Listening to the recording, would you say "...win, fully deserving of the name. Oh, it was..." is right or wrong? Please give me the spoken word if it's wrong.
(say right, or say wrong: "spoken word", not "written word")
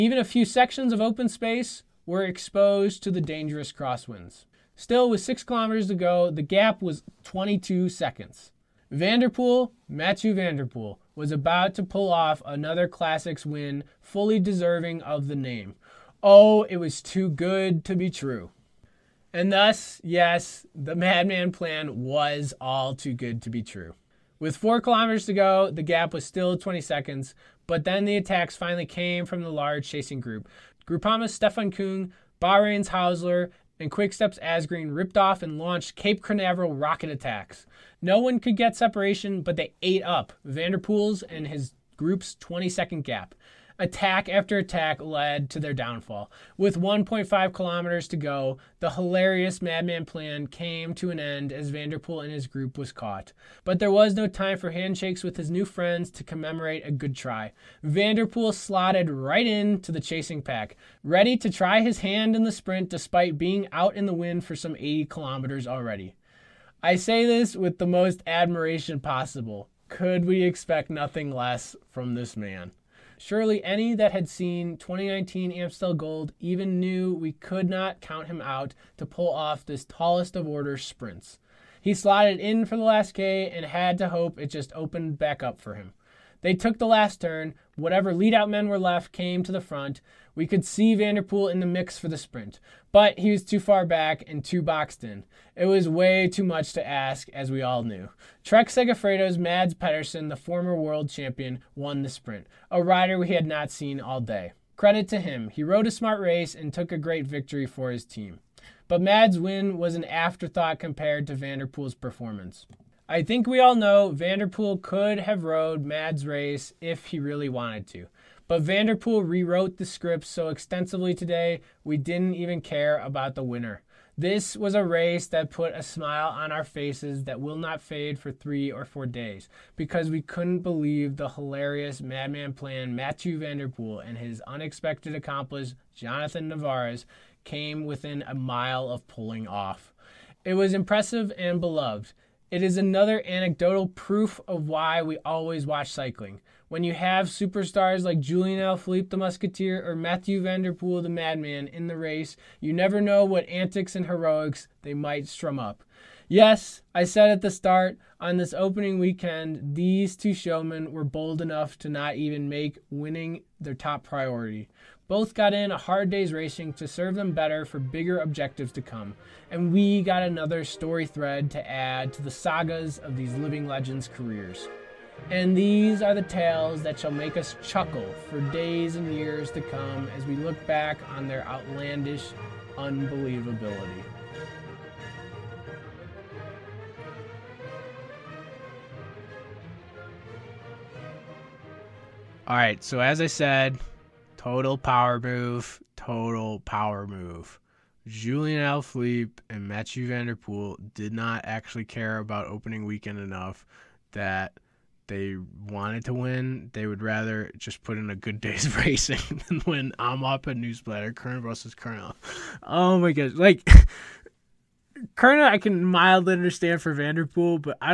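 right.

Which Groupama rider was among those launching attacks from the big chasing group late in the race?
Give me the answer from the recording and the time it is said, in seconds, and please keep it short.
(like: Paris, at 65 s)
Stefan Kung, at 31 s.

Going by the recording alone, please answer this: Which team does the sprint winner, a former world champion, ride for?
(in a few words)
Trek Segafredo.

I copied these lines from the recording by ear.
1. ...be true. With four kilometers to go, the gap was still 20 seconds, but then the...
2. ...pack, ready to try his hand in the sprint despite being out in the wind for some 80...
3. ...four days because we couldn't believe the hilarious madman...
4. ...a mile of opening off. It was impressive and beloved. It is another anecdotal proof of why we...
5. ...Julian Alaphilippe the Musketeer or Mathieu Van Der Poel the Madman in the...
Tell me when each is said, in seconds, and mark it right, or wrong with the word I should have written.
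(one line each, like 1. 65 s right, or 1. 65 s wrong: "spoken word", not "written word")
1. 23 s right
2. 60 s right
3. 128 s right
4. 138 s wrong: "pulling", not "opening"
5. 148 s right.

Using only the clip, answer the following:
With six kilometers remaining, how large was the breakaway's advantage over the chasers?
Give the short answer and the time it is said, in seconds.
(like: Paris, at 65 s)
22 seconds, at 7 s.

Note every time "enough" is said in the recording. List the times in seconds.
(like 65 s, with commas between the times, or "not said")
161 s, 203 s.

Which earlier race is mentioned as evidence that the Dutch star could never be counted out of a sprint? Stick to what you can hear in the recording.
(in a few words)
2019 Amstel Gold.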